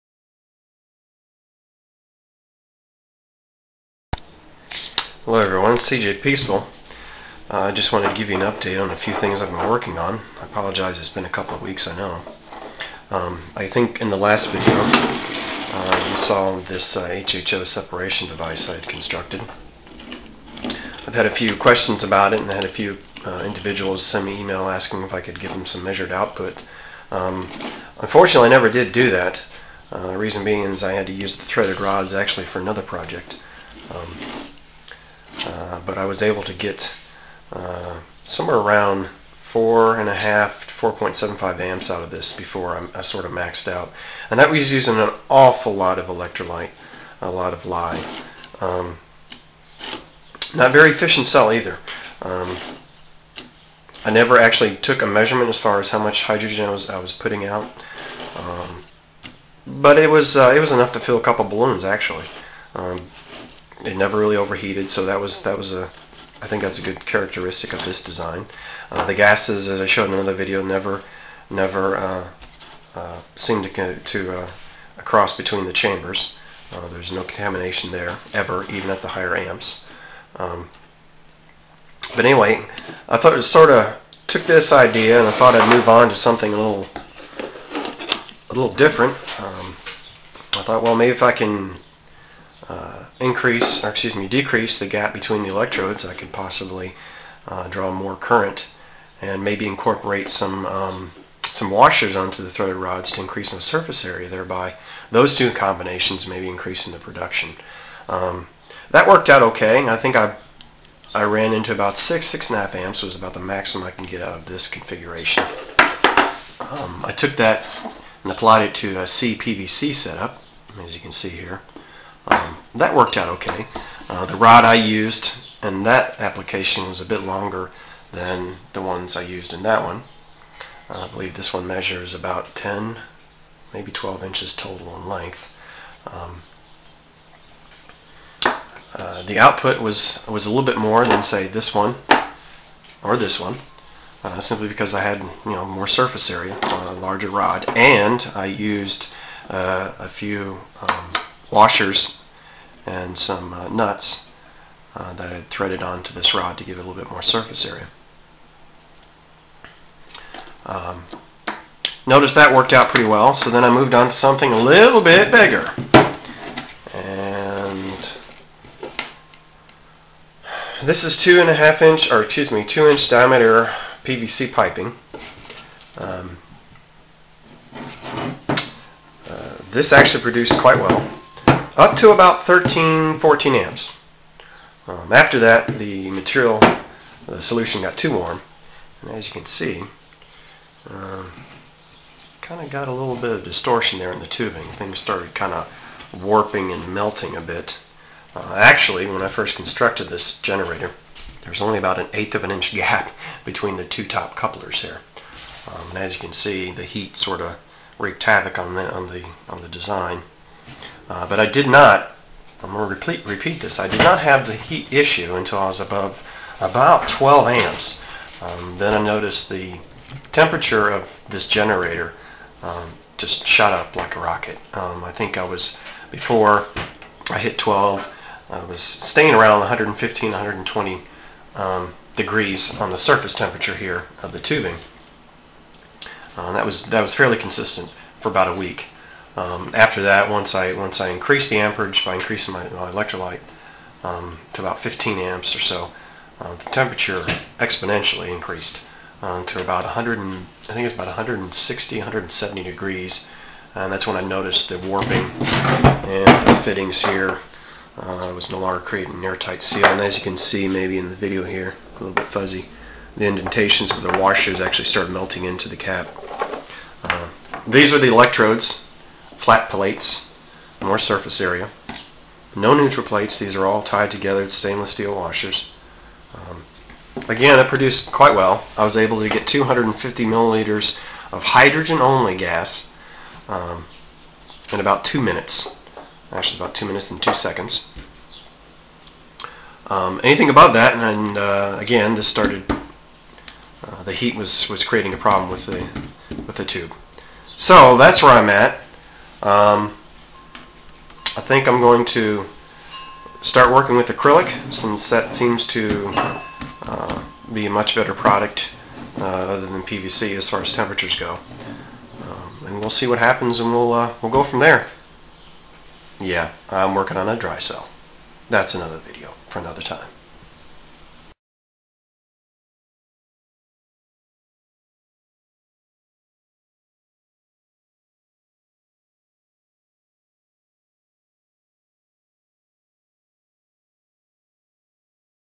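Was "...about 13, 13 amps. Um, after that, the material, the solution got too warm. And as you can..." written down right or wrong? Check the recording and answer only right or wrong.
wrong.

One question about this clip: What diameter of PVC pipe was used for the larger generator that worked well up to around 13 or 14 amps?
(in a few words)
2 inch.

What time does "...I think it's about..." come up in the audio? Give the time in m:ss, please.
4:10.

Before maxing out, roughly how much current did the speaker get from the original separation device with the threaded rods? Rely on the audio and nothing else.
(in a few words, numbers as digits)
4.75 amps.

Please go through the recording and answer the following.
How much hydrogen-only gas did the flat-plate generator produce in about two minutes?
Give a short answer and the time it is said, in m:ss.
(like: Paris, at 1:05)
250 milliliters, at 4:39.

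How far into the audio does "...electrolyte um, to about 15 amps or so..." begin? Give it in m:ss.
4:02.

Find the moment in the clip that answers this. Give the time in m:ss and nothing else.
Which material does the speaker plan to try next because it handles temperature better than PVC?
5:04.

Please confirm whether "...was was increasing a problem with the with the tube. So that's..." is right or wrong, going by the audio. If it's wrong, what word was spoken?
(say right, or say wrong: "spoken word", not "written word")
wrong: "creating", not "increasing".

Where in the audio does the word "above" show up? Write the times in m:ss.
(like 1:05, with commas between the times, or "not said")
3:35, 4:50.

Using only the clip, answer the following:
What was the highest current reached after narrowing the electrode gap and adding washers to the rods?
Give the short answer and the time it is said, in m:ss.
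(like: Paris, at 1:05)
6.5 amps, at 1:52.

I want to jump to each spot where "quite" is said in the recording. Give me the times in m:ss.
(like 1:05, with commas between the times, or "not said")
3:00, 4:38.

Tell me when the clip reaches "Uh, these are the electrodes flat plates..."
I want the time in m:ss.
4:27.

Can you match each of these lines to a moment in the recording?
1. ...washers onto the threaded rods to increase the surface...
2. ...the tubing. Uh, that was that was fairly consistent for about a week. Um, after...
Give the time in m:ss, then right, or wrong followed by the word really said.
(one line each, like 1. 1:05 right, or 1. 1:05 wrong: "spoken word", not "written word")
1. 1:41 right
2. 3:54 right.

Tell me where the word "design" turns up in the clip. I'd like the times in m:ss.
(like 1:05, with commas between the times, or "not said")
1:08, 3:29.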